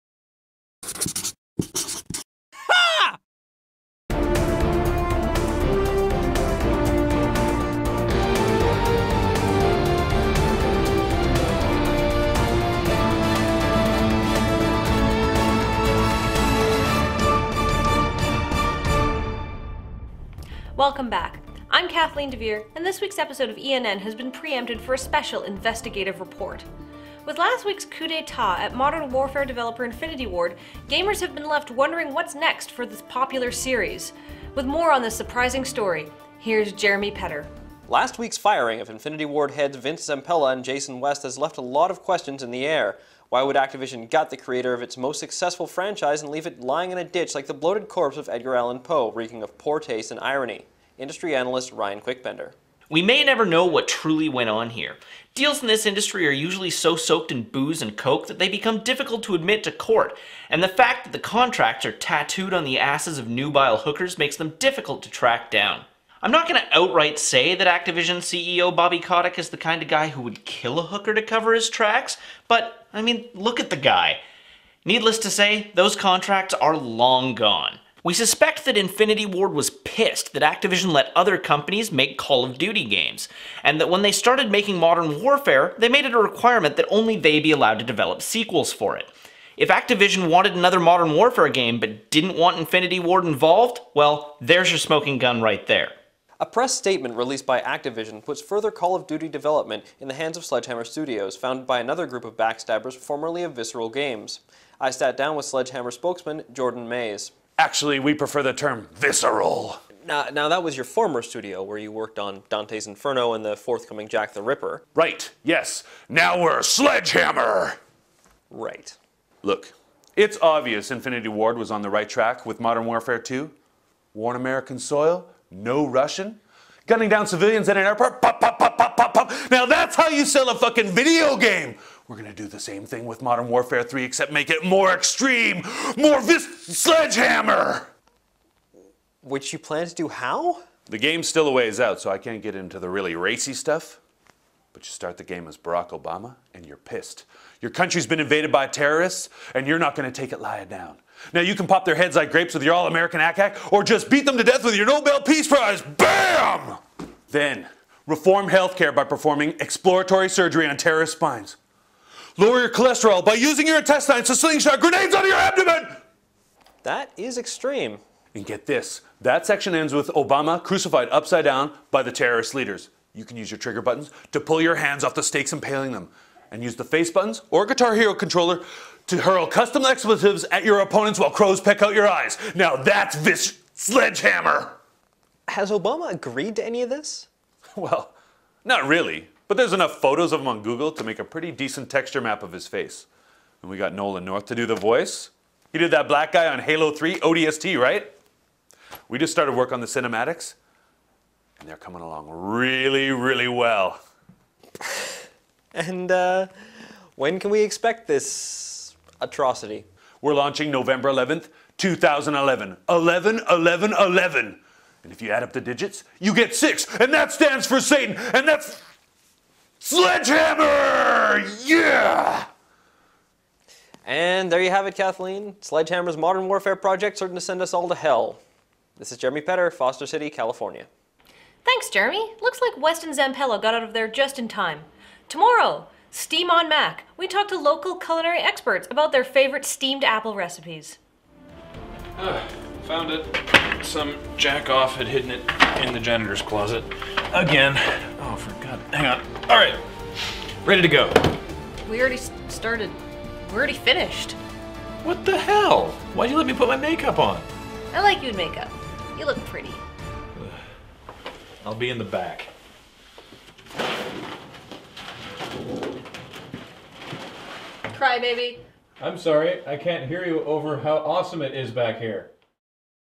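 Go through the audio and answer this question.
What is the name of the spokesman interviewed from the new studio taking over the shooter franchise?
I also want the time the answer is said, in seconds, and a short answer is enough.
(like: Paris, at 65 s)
Jordan Mays, at 106 s.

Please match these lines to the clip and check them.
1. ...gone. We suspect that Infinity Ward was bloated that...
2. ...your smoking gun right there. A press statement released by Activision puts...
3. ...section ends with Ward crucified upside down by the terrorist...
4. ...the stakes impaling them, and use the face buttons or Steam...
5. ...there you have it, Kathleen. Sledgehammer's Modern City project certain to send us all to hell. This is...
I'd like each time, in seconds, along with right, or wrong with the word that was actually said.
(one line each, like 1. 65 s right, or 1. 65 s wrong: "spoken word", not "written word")
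1. 77 s wrong: "pissed", not "bloated"
2. 94 s right
3. 169 s wrong: "Obama", not "Ward"
4. 175 s wrong: "Guitar", not "Steam"
5. 224 s wrong: "Warfare", not "City".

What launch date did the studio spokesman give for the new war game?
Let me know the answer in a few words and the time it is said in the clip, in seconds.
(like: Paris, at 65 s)
November 11, 2011, at 210 s.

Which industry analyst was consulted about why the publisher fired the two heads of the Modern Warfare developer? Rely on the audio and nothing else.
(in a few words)
Ryan Quickbender.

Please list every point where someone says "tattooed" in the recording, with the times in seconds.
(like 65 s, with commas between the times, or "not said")
61 s.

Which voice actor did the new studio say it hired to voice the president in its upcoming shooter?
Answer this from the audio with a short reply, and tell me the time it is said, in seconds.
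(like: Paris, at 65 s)
Nolan North, at 193 s.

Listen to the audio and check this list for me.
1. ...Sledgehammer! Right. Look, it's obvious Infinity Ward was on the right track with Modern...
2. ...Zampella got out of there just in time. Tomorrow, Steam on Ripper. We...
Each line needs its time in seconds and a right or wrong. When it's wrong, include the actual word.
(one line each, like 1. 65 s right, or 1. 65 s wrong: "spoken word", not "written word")
1. 116 s right
2. 233 s wrong: "Mac", not "Ripper".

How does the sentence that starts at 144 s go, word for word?
But you start the game as Barack Obama, and you're pissed.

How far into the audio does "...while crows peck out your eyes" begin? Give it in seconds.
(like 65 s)
181 s.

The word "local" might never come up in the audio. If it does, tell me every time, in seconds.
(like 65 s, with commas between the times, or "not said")
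237 s.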